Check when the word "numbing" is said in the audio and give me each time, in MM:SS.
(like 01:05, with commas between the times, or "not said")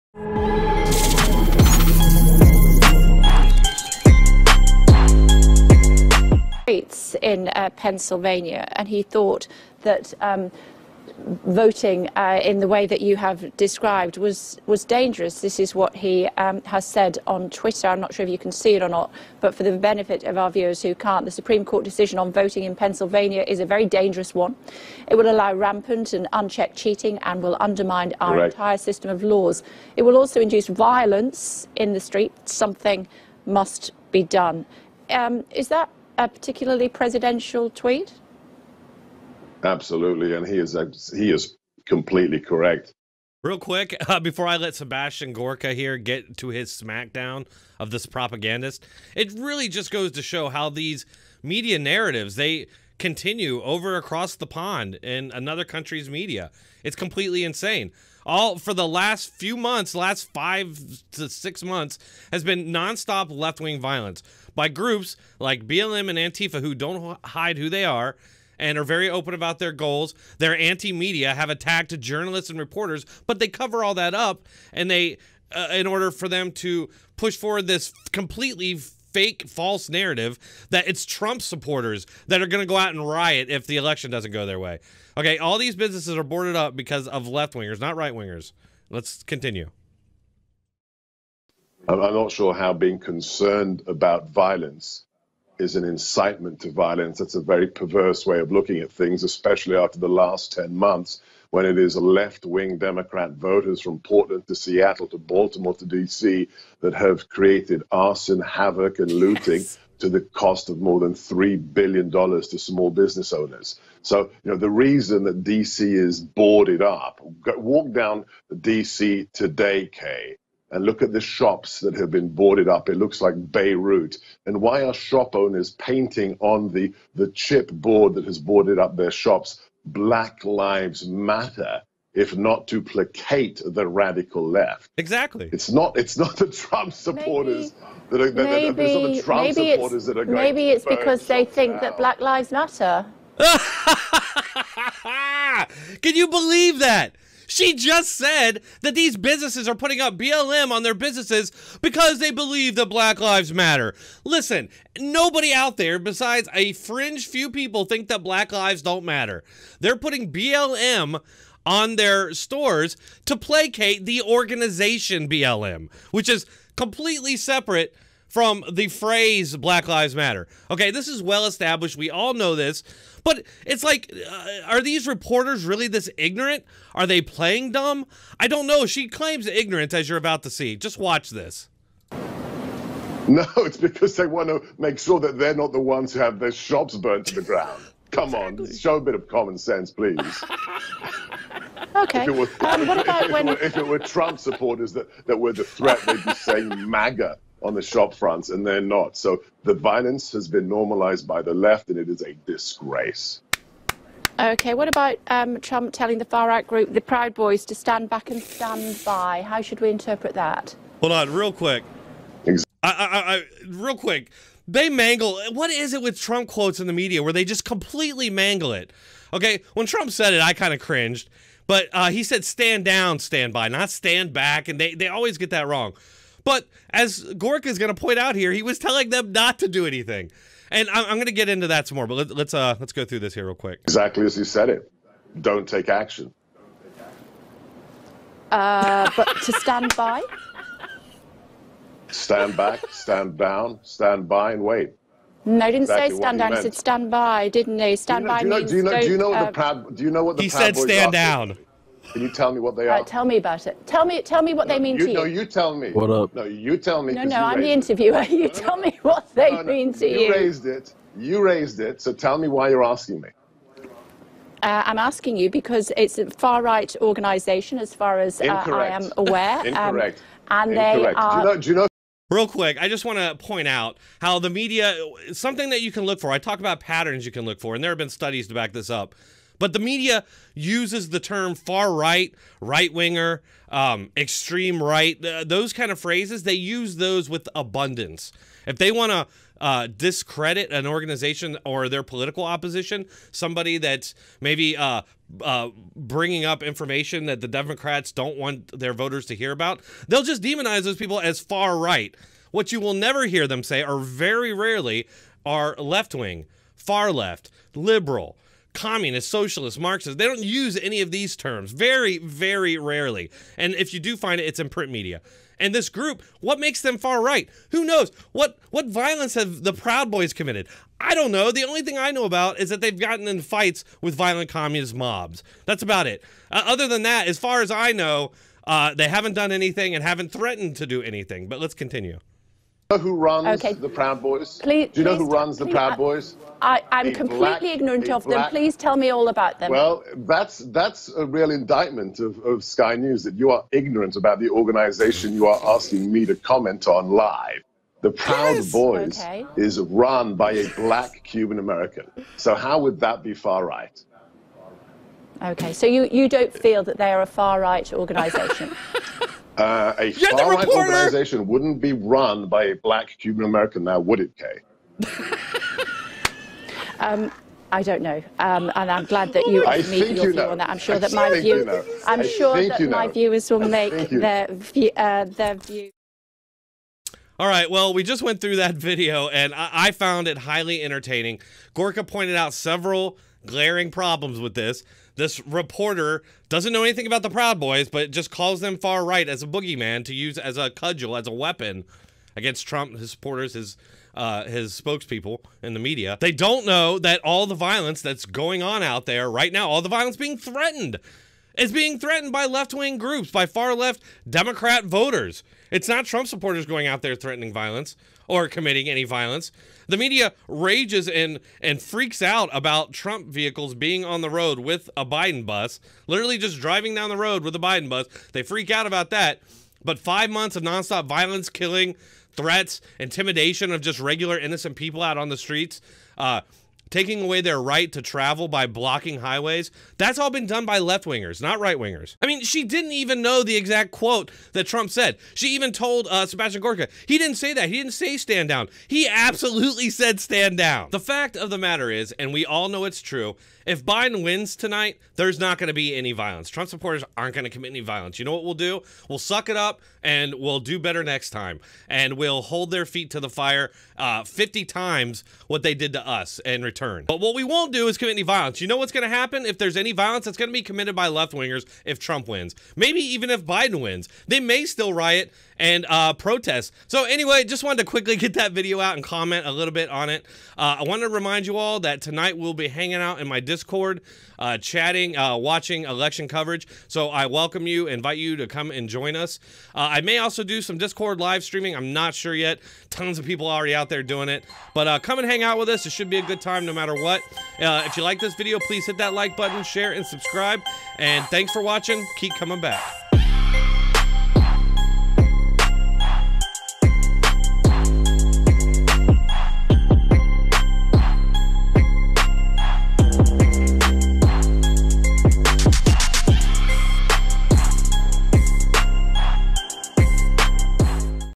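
not said.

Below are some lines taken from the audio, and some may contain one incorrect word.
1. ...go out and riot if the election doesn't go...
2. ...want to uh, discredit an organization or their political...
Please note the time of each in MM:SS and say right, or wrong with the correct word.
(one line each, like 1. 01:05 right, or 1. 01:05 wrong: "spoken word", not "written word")
1. 01:22 right
2. 04:48 right.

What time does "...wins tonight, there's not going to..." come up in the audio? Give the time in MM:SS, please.
07:24.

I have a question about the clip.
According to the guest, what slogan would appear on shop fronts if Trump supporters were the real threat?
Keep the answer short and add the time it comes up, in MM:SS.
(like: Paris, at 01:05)
MAGA, at 03:16.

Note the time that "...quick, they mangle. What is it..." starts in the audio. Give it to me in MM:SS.
03:33.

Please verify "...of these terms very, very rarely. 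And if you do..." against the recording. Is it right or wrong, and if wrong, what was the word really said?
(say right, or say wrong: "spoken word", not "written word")
right.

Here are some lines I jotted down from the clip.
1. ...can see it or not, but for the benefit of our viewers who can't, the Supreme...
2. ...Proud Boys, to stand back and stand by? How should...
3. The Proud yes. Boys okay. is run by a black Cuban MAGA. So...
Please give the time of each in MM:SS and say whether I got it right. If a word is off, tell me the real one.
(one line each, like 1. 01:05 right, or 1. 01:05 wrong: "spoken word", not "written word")
1. 00:18 right
2. 03:27 right
3. 05:48 wrong: "American", not "MAGA".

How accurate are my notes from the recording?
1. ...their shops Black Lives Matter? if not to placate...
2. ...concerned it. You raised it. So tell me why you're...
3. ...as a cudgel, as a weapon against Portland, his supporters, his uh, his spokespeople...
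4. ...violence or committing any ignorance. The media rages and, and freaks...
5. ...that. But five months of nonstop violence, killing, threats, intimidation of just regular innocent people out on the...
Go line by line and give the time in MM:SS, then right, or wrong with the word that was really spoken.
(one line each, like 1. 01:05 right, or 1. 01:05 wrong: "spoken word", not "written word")
1. 02:08 right
2. 04:20 wrong: "raised", not "concerned"
3. 06:30 wrong: "Trump", not "Portland"
4. 06:47 wrong: "violence", not "ignorance"
5. 06:59 right.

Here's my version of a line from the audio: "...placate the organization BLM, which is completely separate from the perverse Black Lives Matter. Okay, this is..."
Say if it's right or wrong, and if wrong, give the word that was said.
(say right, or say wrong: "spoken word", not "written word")
wrong: "phrase", not "perverse".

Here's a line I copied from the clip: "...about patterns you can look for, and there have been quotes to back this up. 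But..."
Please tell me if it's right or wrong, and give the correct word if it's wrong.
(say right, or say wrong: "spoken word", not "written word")
wrong: "studies", not "quotes".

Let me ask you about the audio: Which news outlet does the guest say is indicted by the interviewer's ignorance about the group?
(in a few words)
Sky News.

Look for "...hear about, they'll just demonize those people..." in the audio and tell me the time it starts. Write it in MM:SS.
04:59.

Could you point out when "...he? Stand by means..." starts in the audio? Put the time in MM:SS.
04:07.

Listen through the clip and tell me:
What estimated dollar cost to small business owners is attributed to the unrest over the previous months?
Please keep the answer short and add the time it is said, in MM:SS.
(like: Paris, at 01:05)
more than $3 billion, at 01:50.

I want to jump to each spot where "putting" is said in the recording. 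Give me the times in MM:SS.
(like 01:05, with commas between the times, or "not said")
02:29, 02:39.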